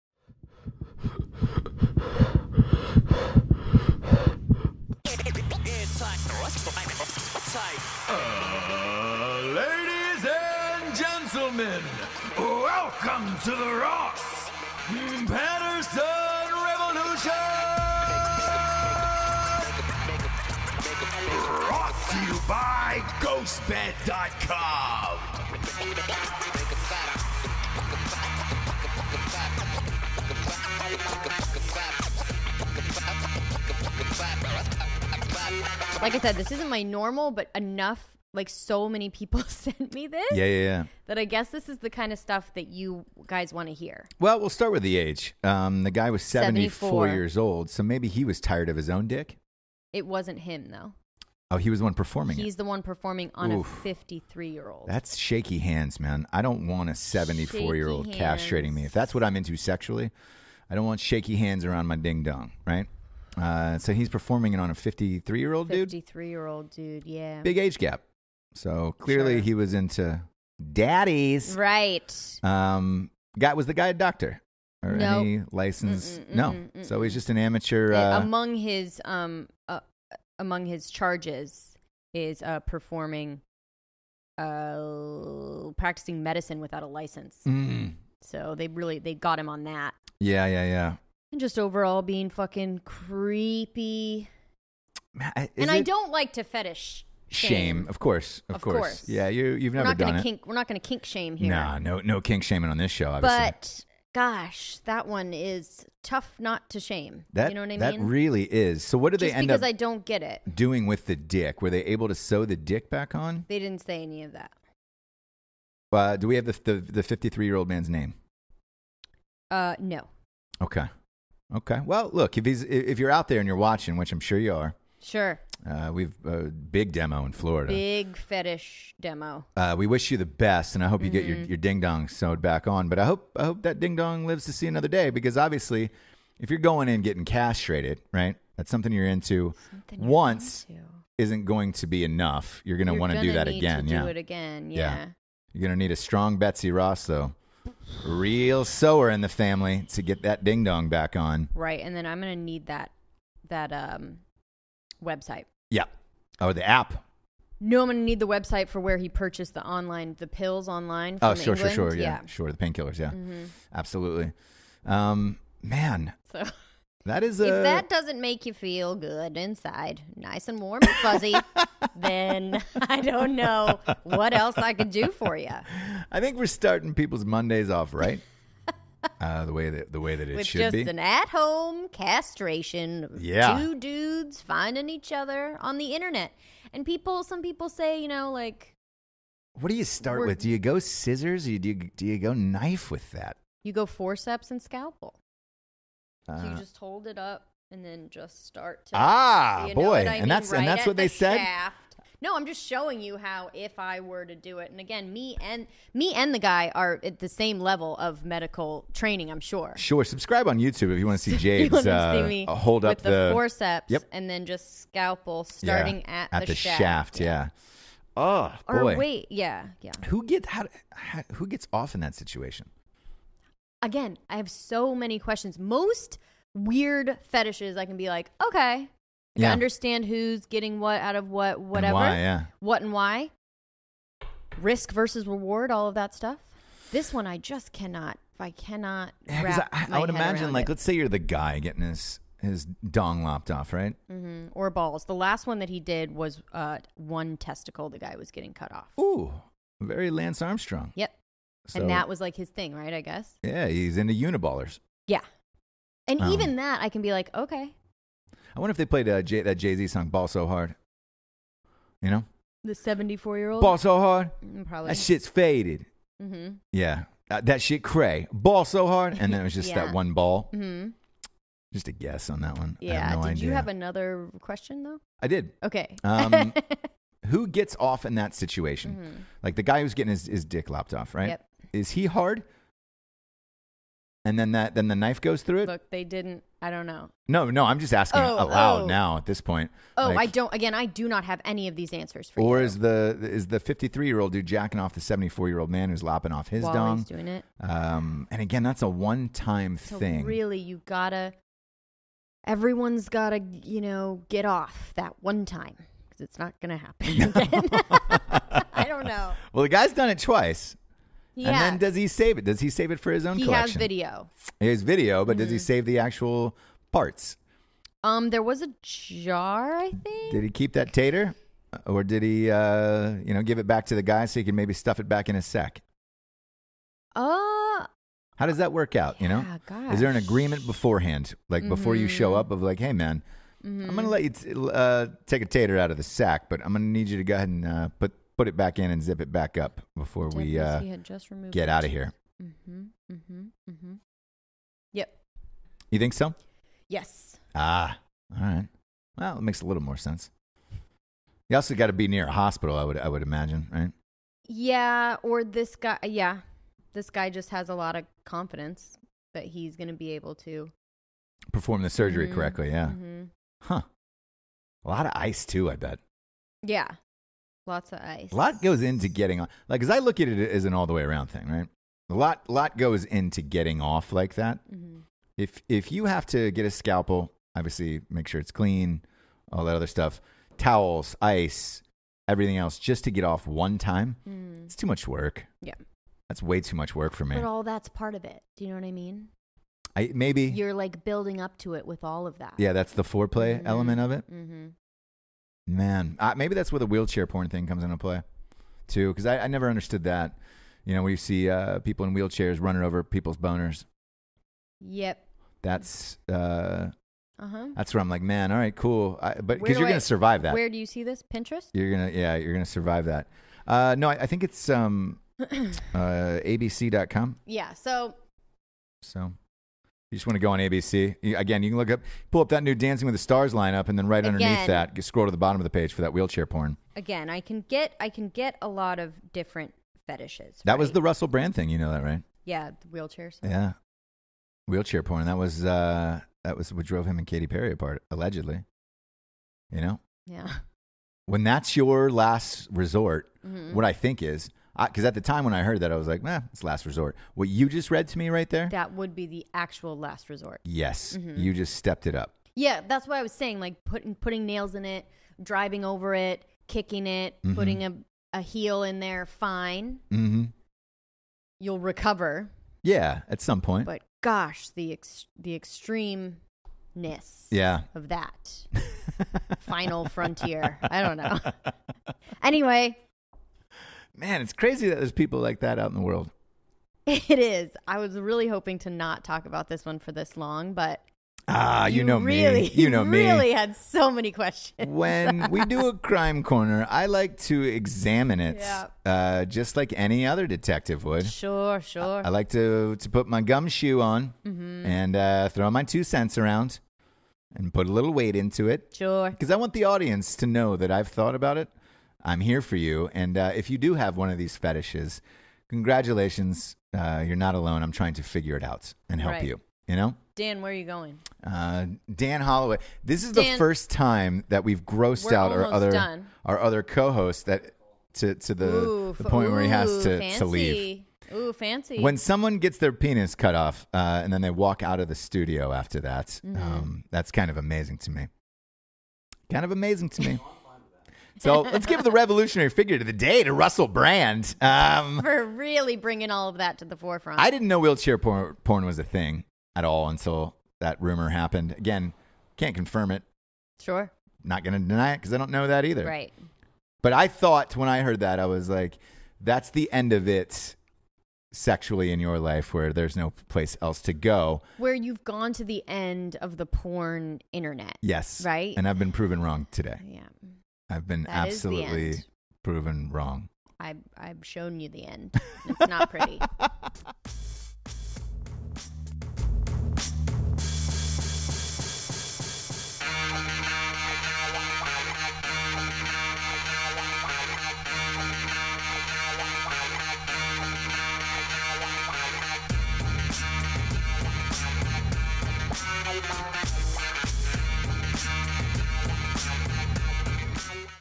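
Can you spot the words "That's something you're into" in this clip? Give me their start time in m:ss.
2:18.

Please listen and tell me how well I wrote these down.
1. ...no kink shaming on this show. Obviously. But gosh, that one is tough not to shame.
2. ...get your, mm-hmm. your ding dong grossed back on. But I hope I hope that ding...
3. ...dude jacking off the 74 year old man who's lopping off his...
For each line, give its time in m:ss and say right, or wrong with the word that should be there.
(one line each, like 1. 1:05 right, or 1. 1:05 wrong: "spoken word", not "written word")
1. 1:42 right
2. 2:11 wrong: "sewed", not "grossed"
3. 4:54 right.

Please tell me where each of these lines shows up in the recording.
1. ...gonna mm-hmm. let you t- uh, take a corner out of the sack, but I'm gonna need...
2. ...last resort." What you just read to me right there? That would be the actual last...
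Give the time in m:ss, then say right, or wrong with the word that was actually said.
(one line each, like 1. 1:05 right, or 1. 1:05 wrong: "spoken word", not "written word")
1. 5:33 wrong: "tater", not "corner"
2. 7:26 right.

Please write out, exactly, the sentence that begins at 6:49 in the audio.
I, but because you're going to survive that.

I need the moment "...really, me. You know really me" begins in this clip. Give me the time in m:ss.
8:02.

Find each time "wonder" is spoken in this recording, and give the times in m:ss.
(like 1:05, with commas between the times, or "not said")
4:18.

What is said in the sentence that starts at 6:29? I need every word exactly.
I maybe you're like building up to it with all of that.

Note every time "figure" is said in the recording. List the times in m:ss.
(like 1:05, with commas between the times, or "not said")
8:28, 8:52.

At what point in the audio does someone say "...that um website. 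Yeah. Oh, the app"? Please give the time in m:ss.
2:33.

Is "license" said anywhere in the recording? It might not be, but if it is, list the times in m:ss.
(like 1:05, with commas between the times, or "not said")
1:15, 1:26.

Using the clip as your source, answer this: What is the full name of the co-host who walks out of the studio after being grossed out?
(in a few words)
Dan Holloway.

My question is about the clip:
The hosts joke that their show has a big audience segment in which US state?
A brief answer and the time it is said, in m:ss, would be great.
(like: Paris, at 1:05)
Florida, at 2:07.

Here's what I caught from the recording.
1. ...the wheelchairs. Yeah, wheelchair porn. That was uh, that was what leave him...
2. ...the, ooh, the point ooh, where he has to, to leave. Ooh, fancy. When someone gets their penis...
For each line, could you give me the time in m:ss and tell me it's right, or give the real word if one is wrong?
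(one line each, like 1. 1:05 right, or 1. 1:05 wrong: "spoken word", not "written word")
1. 7:12 wrong: "drove", not "leave"
2. 8:38 right.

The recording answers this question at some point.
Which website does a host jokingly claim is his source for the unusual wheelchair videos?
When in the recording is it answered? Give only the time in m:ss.
6:55.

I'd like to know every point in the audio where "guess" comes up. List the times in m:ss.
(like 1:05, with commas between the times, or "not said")
0:41, 4:13, 4:31.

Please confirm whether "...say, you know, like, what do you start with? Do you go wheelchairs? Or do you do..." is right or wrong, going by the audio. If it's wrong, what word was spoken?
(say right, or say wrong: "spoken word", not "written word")
wrong: "scissors", not "wheelchairs".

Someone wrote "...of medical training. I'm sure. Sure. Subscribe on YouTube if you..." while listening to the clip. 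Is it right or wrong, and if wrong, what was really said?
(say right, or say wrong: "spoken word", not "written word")
right.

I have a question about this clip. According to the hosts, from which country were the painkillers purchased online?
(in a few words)
England.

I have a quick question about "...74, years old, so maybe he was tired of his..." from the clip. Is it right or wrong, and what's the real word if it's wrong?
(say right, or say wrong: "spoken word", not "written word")
right.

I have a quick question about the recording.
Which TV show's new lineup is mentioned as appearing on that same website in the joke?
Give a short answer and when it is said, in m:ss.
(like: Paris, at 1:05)
Dancing with the Stars, at 7:02.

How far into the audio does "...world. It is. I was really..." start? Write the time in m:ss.
7:56.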